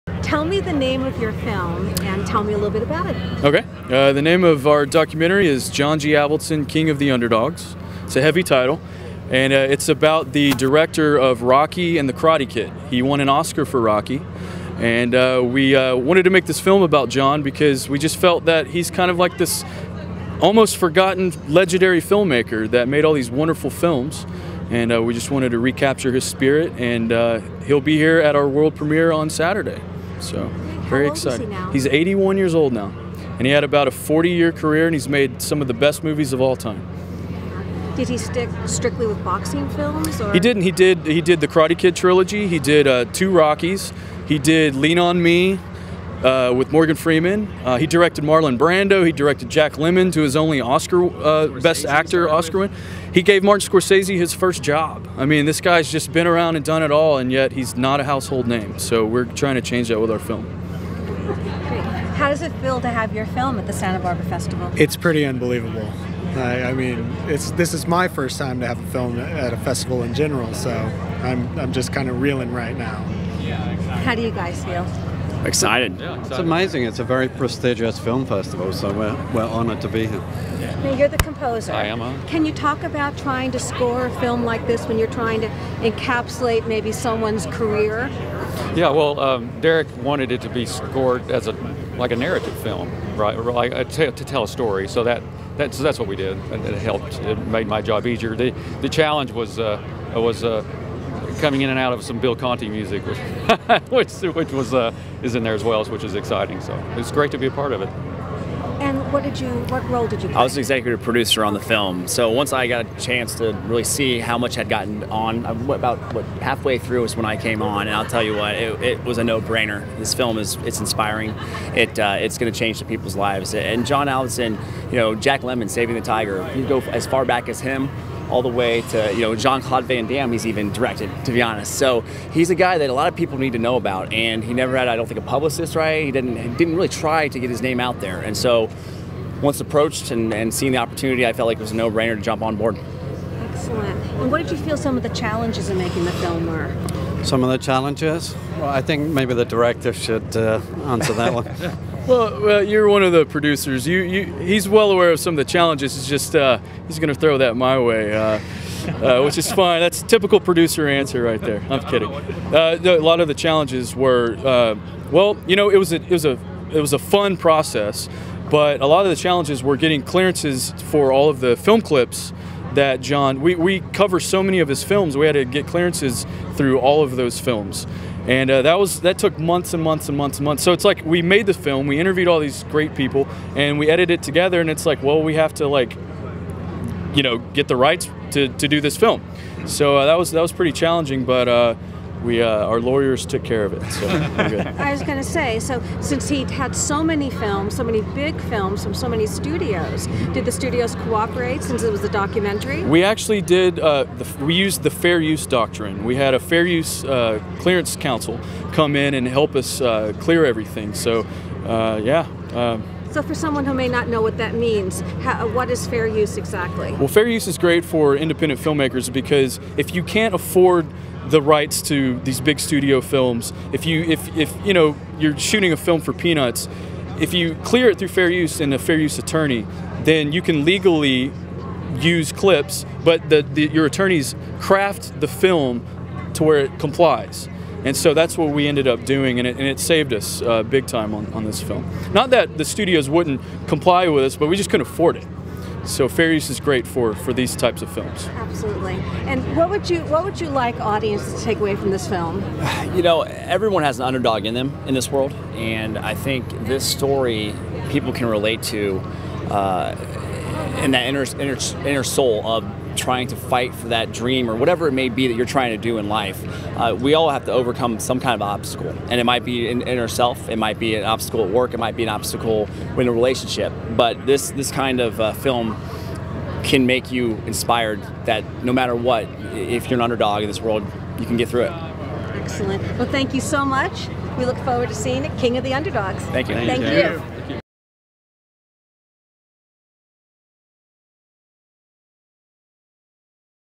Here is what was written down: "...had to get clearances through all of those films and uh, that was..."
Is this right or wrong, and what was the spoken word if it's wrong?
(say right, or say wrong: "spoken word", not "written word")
right.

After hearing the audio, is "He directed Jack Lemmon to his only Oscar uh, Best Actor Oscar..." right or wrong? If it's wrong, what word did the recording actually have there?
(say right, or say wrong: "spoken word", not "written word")
right.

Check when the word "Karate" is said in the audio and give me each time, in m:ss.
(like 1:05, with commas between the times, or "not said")
0:12, 0:41.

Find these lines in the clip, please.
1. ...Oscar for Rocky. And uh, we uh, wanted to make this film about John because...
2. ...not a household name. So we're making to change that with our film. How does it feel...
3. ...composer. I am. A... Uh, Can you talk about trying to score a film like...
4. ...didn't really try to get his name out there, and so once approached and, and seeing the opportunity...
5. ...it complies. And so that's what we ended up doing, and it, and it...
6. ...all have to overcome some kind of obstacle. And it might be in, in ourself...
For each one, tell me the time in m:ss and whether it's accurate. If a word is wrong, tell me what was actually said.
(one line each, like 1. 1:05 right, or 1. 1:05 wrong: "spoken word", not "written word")
1. 0:13 right
2. 0:57 wrong: "trying", not "making"
3. 1:21 right
4. 2:16 right
5. 3:56 right
6. 4:27 right.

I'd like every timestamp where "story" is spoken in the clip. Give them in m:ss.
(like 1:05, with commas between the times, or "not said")
1:34, 4:16.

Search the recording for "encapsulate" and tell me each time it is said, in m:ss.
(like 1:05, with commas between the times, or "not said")
1:25.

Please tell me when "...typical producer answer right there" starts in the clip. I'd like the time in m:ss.
2:40.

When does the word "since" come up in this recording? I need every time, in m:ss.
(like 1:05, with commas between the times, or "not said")
3:16, 3:21.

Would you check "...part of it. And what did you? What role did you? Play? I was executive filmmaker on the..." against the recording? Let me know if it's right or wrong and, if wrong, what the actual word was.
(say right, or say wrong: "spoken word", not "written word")
wrong: "producer", not "filmmaker".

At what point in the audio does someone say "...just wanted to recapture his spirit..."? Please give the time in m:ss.
0:25.